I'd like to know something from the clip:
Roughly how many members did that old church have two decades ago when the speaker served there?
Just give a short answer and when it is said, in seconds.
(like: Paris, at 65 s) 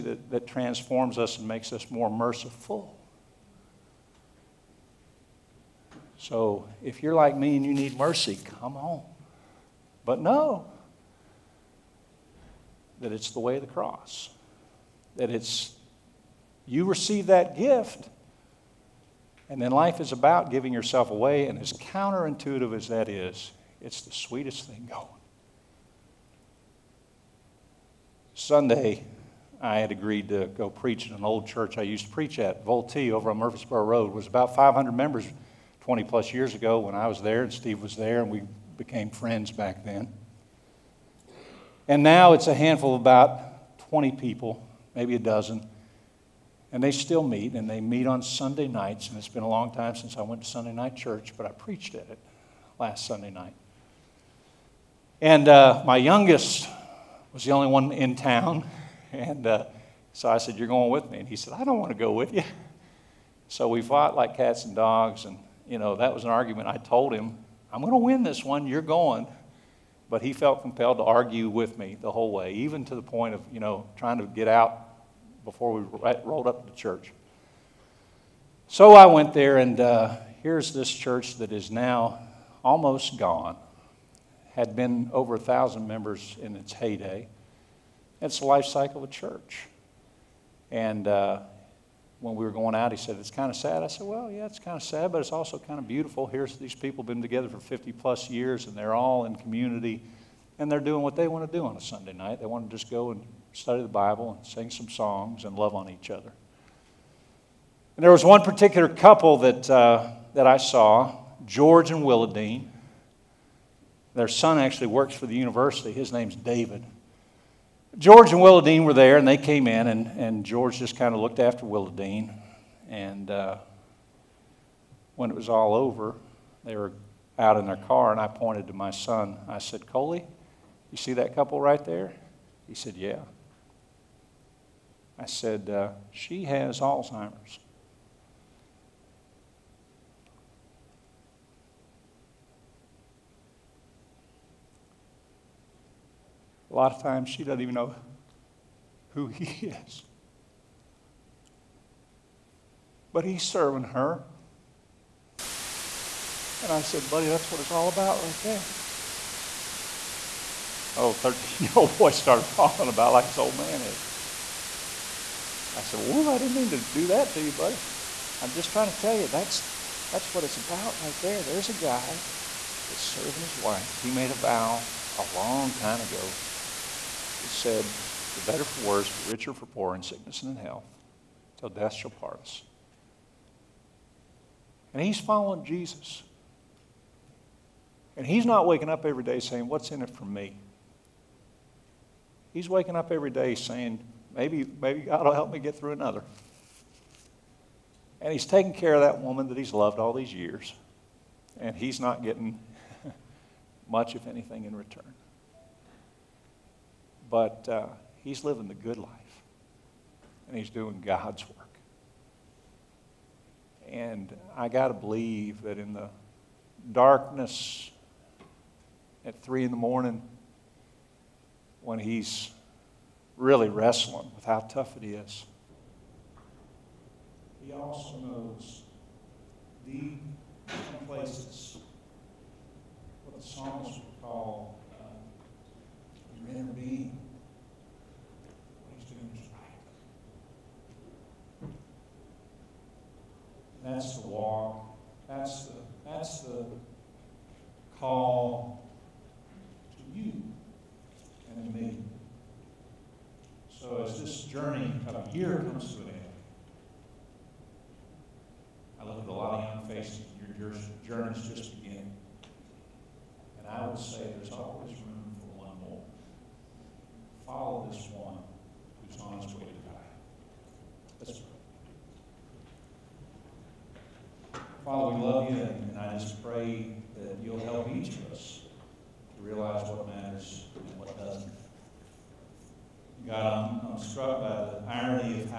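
500, at 34 s.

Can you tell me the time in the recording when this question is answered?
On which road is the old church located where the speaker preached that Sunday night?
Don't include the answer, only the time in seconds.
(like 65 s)
33 s.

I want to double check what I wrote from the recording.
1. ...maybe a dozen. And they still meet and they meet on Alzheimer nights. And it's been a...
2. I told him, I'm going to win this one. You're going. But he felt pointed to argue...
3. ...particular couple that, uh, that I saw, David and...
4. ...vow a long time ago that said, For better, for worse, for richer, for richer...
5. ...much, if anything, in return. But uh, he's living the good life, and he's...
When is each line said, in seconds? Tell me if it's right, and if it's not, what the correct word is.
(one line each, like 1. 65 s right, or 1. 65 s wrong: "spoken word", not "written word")
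1. 44 s wrong: "Sunday", not "Alzheimer"
2. 66 s wrong: "compelled", not "pointed"
3. 108 s wrong: "George", not "David"
4. 174 s wrong: "poorer", not "richer"
5. 203 s right.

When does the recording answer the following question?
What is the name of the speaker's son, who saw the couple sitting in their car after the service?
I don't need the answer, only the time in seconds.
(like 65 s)
129 s.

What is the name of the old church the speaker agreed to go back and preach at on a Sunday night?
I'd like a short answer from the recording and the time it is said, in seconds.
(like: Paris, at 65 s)
Vultee, at 32 s.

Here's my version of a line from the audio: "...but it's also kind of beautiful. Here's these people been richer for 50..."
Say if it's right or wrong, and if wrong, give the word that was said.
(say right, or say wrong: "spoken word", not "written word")
wrong: "together", not "richer".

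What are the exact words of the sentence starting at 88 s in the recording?
It's the life cycle of a church.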